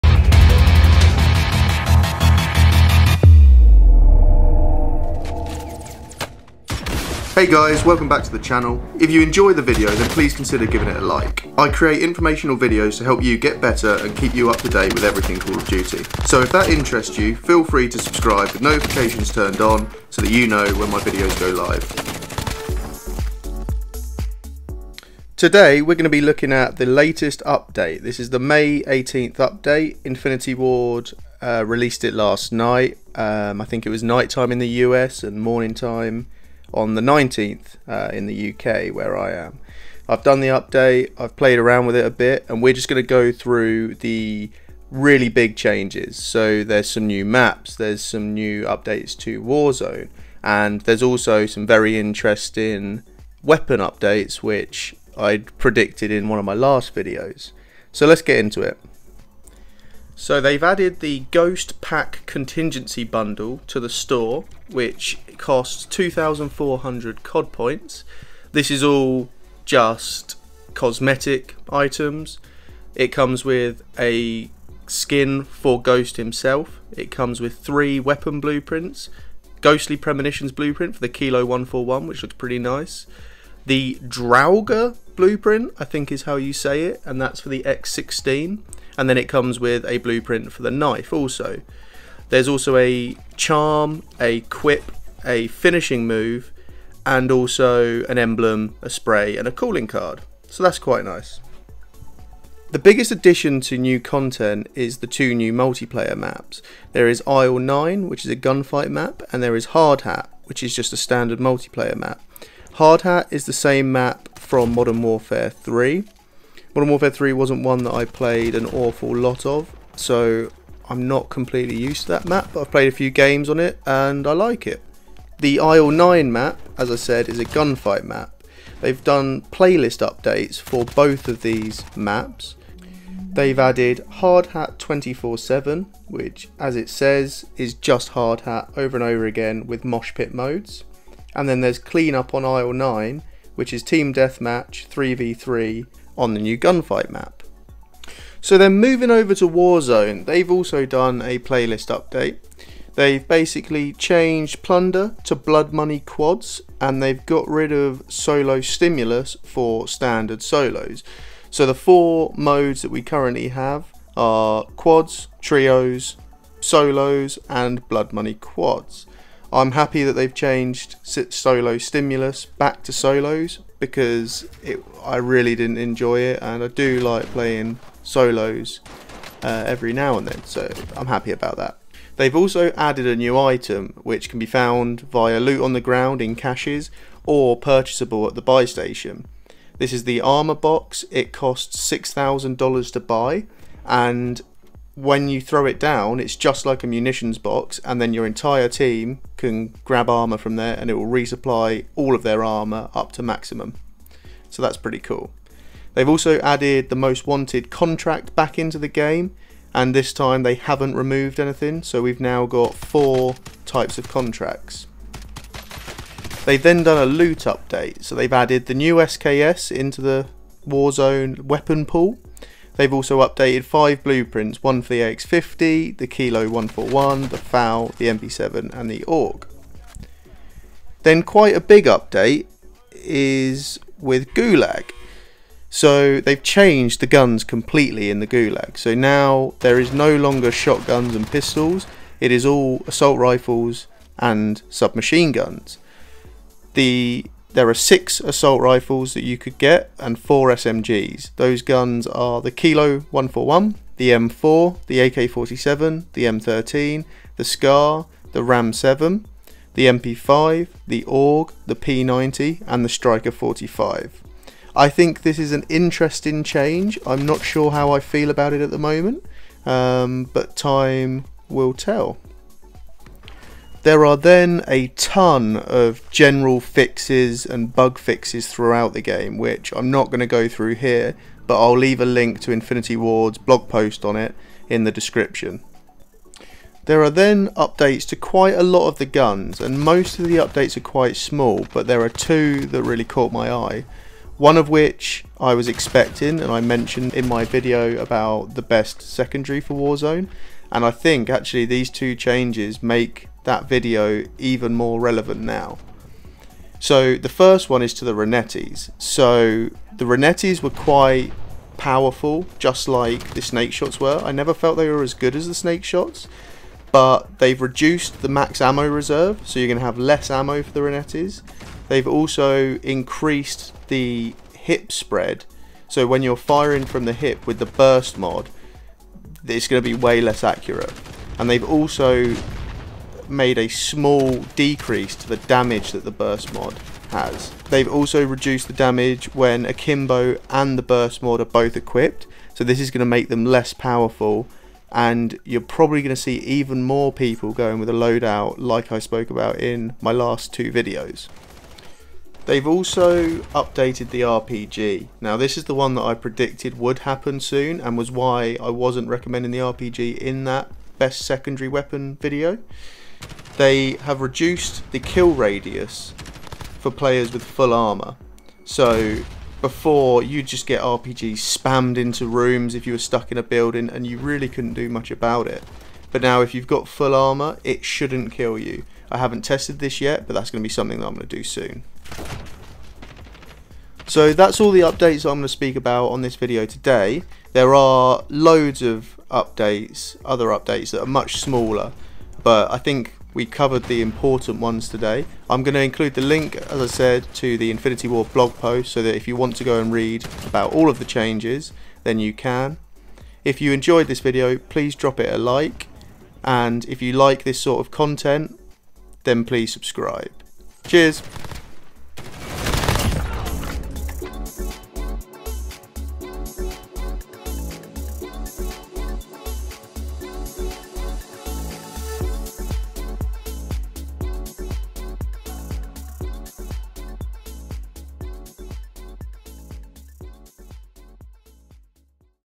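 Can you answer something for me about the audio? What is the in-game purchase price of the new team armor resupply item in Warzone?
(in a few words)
$6,000.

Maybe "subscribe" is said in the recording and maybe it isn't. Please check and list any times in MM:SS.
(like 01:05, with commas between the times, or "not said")
00:17, 06:49.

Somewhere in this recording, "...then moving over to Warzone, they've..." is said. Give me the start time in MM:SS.
02:28.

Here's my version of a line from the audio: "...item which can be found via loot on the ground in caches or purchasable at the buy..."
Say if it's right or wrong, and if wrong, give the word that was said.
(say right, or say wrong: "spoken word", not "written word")
right.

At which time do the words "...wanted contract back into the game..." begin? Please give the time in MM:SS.
03:27.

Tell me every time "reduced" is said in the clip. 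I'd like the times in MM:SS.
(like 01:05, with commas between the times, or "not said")
05:17, 05:38, 06:04.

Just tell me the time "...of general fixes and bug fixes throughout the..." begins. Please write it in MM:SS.
04:35.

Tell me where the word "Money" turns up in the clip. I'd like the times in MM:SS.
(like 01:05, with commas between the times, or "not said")
02:35, 02:48.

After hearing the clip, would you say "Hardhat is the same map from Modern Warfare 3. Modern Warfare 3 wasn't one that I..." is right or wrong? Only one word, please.
right.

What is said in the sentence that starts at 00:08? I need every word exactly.
If you enjoy the video, then please consider giving it a like.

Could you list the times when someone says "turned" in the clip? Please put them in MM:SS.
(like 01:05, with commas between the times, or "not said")
00:19.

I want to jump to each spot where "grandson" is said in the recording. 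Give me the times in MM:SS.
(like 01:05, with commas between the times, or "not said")
not said.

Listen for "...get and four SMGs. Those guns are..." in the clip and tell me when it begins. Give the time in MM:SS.
04:09.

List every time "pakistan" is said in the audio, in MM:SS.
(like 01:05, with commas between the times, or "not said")
not said.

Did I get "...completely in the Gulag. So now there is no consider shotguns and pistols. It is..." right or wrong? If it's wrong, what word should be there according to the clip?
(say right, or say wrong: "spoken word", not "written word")
wrong: "longer", not "consider".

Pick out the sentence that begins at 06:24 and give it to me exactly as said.
So that's all the updates I'm going to speak about on this video today.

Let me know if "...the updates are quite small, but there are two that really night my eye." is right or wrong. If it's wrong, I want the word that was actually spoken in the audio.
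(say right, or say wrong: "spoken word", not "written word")
wrong: "caught", not "night".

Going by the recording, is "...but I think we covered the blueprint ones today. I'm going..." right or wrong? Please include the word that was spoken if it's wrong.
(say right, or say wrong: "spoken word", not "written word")
wrong: "important", not "blueprint".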